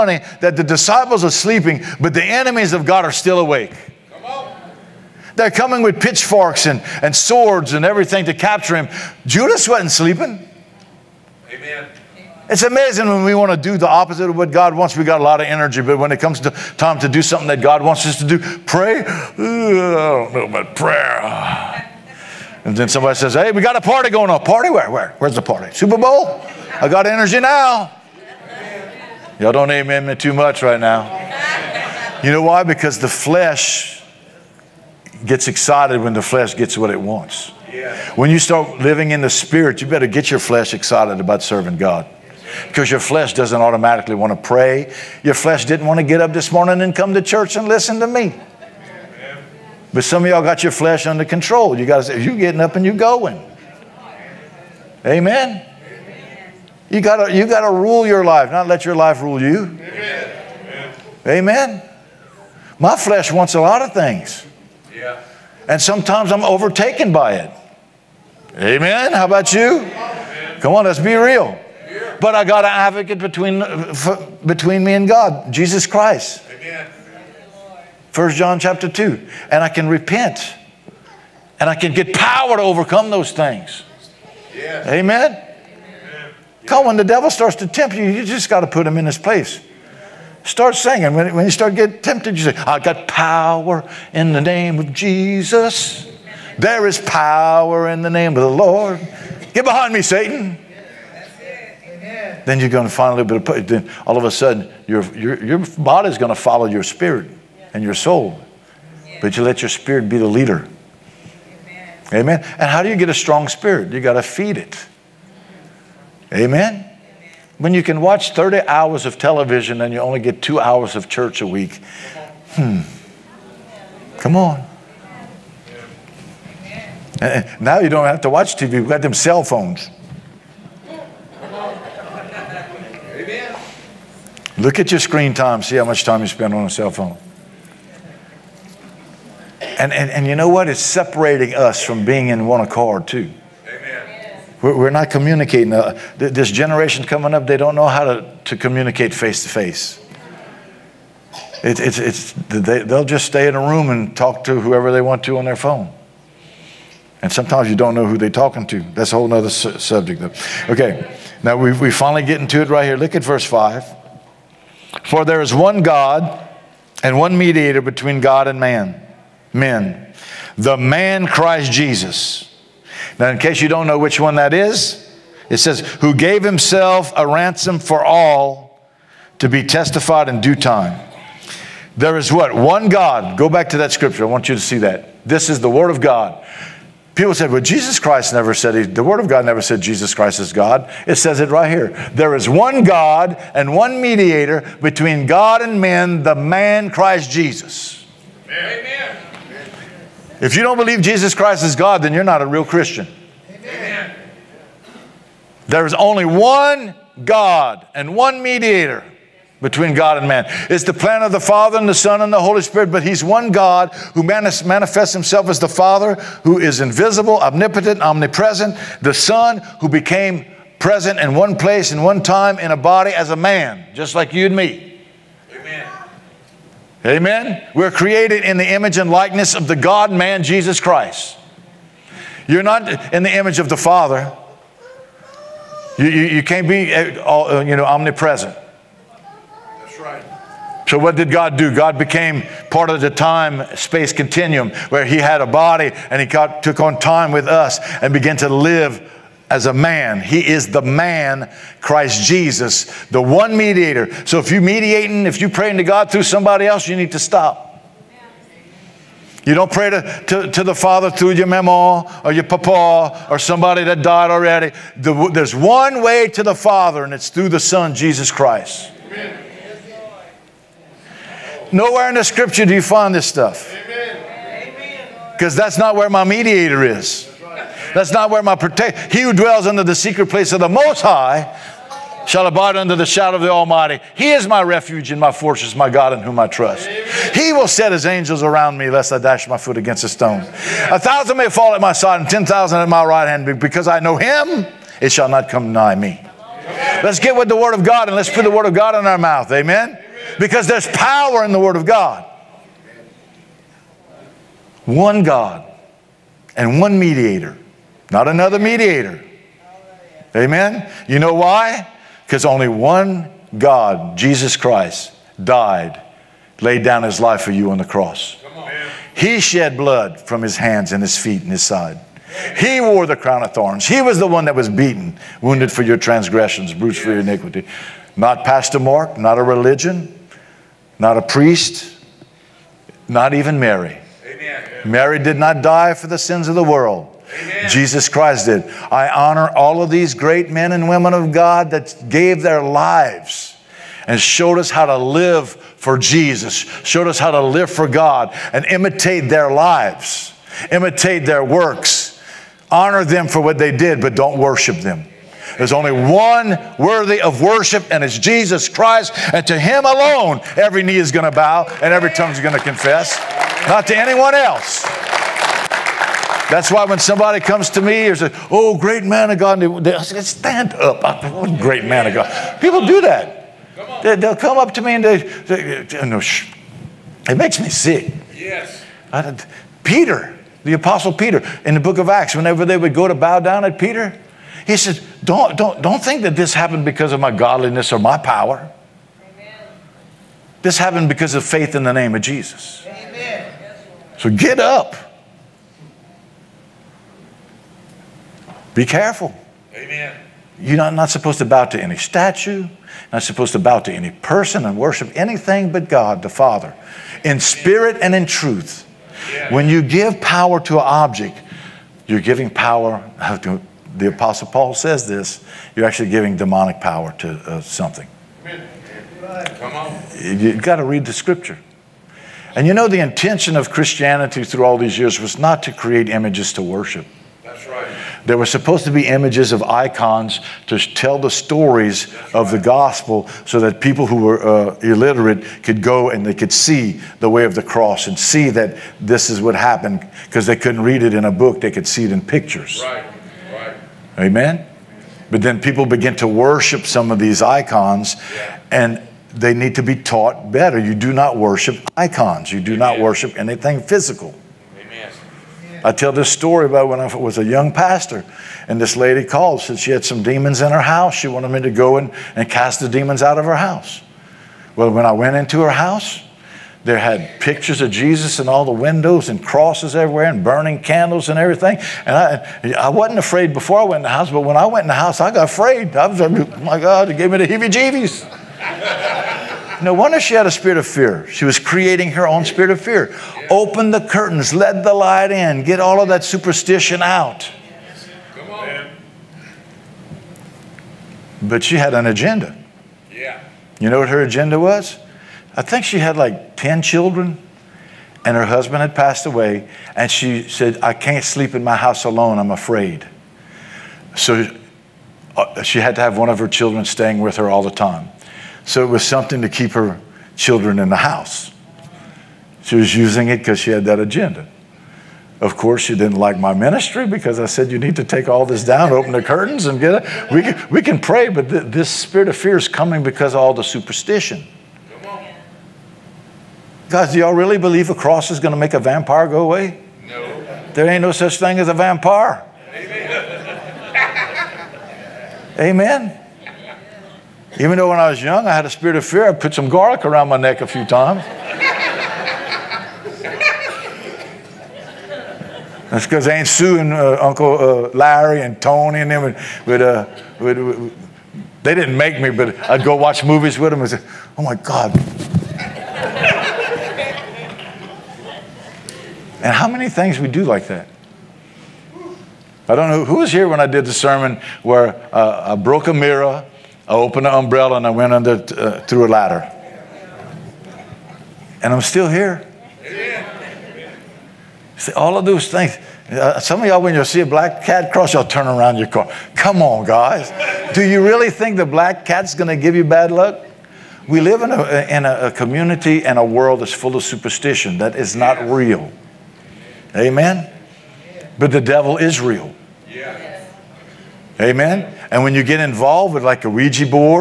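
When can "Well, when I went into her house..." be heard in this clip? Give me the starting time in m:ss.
7:44.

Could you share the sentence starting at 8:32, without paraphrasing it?
She was using it because she had that agenda.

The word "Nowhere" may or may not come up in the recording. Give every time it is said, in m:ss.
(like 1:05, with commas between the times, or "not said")
4:31.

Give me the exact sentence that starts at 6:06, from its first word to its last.
That's why when somebody comes to me or says, Oh, great man of God, they, I say, Stand up.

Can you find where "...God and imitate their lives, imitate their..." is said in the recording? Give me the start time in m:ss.
5:47.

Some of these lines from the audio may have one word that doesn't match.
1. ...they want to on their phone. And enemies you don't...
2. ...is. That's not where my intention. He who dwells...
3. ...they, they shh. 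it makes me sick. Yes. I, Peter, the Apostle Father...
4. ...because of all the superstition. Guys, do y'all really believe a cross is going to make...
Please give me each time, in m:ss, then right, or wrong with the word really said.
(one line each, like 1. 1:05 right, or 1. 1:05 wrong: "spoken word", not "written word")
1. 2:34 wrong: "sometimes", not "enemies"
2. 4:36 wrong: "protection", not "intention"
3. 6:15 wrong: "Peter", not "Father"
4. 8:43 right.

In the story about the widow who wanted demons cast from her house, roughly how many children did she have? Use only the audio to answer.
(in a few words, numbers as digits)
10.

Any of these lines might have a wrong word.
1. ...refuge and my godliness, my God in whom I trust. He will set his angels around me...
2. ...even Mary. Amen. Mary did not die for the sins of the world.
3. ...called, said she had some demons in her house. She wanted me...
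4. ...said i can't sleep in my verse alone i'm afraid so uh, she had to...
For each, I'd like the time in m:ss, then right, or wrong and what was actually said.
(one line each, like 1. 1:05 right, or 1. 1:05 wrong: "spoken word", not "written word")
1. 4:44 wrong: "fortress", not "godliness"
2. 5:33 right
3. 7:39 right
4. 8:20 wrong: "house", not "verse".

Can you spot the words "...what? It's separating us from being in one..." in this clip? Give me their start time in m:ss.
2:20.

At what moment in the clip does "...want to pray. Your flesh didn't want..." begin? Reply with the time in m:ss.
0:44.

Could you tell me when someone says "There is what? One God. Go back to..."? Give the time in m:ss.
3:01.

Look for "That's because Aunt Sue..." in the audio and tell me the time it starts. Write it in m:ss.
9:05.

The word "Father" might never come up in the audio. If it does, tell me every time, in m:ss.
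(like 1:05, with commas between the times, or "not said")
3:31, 3:35, 3:53, 4:20, 4:26, 6:46.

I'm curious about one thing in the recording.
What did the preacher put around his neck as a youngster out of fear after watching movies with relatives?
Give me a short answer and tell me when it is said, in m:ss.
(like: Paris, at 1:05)
Garlic, at 8:59.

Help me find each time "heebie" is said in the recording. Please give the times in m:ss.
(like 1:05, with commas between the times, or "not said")
7:57.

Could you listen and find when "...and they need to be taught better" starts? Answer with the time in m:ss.
7:28.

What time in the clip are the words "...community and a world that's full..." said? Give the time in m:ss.
9:45.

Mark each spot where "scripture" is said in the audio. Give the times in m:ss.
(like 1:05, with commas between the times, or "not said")
3:03, 4:32, 7:01.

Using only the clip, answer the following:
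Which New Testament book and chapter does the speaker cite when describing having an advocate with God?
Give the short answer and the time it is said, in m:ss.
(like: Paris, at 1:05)
1 John chapter 2, at 1:18.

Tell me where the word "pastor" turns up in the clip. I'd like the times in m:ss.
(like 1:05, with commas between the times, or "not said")
5:28, 7:37.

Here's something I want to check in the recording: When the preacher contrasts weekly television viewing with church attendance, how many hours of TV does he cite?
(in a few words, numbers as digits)
30.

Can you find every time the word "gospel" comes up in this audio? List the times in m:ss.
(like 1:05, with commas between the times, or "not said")
7:12.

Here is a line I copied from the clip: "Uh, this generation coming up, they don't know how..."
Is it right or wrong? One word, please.
right.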